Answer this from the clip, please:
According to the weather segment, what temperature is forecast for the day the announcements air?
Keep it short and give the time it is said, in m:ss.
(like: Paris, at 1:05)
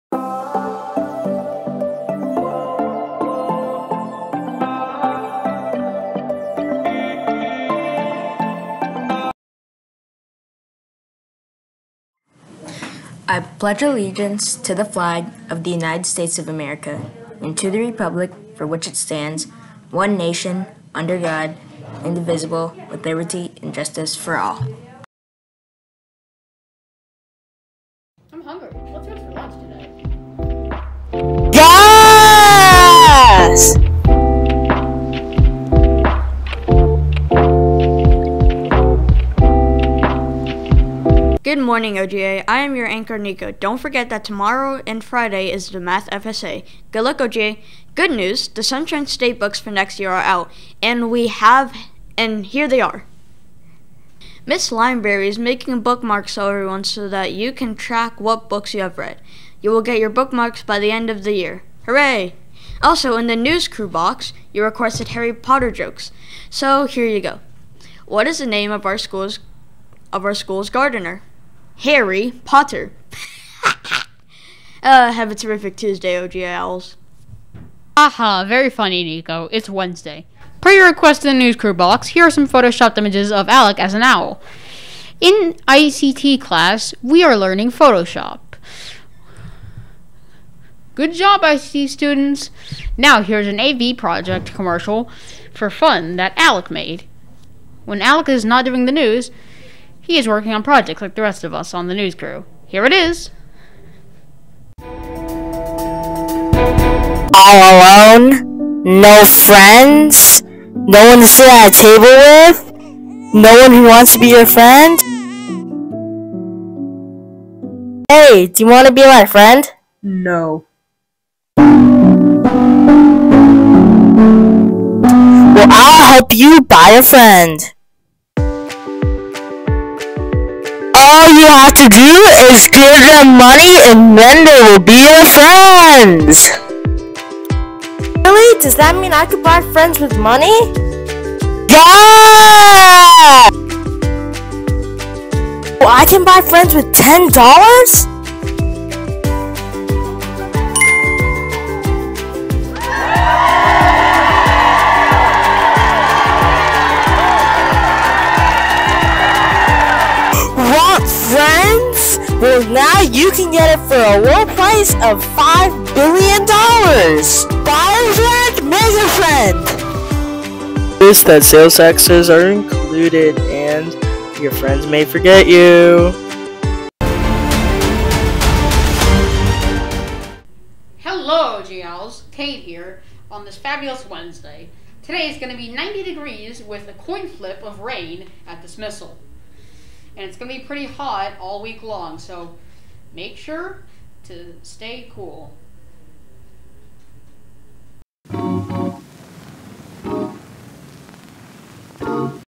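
90 degrees, at 3:05.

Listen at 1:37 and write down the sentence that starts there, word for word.
When Alec is not doing the news, he is working on projects like the rest of us on the news crew.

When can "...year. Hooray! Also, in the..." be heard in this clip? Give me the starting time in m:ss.
1:01.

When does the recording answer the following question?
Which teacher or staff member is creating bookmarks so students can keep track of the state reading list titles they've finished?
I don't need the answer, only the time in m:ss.
0:54.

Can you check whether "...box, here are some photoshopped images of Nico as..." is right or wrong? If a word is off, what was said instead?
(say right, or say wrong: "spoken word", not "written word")
wrong: "Alec", not "Nico".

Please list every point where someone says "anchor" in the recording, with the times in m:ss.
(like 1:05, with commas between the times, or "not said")
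0:42.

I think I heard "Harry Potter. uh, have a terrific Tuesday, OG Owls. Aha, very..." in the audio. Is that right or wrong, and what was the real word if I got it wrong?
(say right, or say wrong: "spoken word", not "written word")
right.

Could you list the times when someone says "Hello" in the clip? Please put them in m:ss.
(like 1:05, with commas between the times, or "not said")
3:01.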